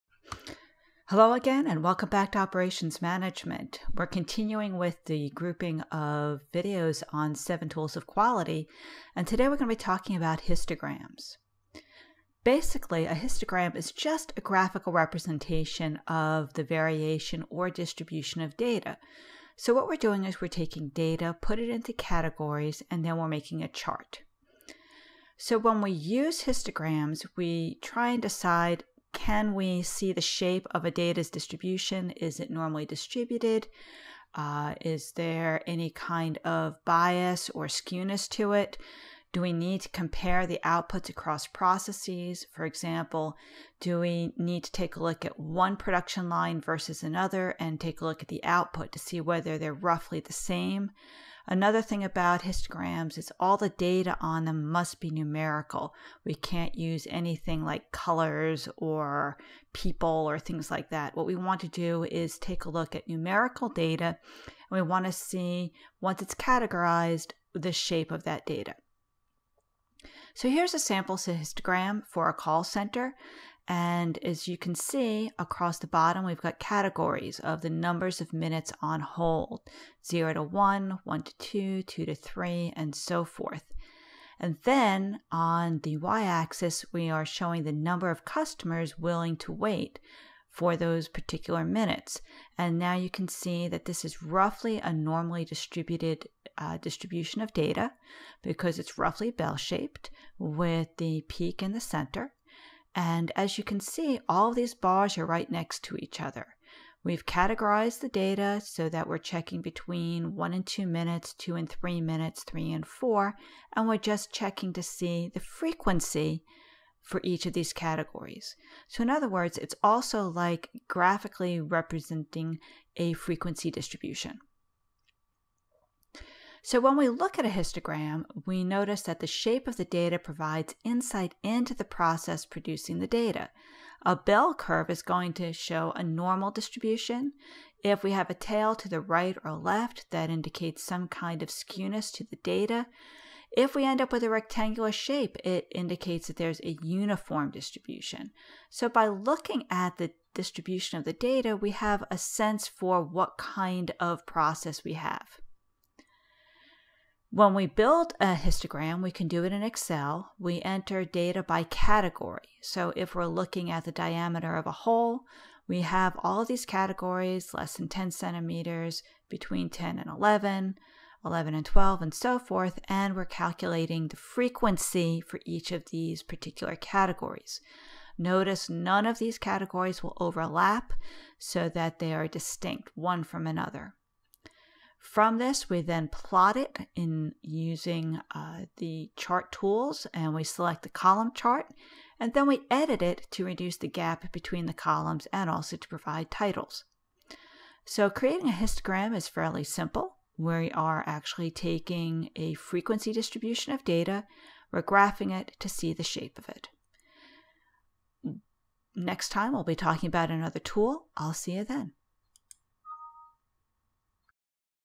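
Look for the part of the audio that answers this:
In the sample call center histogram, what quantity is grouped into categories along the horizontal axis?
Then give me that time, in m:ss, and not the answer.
1:18.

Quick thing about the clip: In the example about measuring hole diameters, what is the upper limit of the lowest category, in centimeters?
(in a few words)
10 centimeters.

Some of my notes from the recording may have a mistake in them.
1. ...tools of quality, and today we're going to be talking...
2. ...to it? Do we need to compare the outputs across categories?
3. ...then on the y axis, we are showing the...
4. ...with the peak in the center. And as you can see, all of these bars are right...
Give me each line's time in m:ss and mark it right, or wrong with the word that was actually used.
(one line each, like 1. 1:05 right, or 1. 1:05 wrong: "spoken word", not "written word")
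1. 0:07 right
2. 0:38 wrong: "processes", not "categories"
3. 1:24 right
4. 1:40 right.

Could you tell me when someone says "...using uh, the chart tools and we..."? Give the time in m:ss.
3:07.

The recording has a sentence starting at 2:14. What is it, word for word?
A bell curve is going to show a normal distribution.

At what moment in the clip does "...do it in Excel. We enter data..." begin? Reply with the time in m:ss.
2:39.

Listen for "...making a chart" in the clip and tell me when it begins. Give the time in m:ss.
0:23.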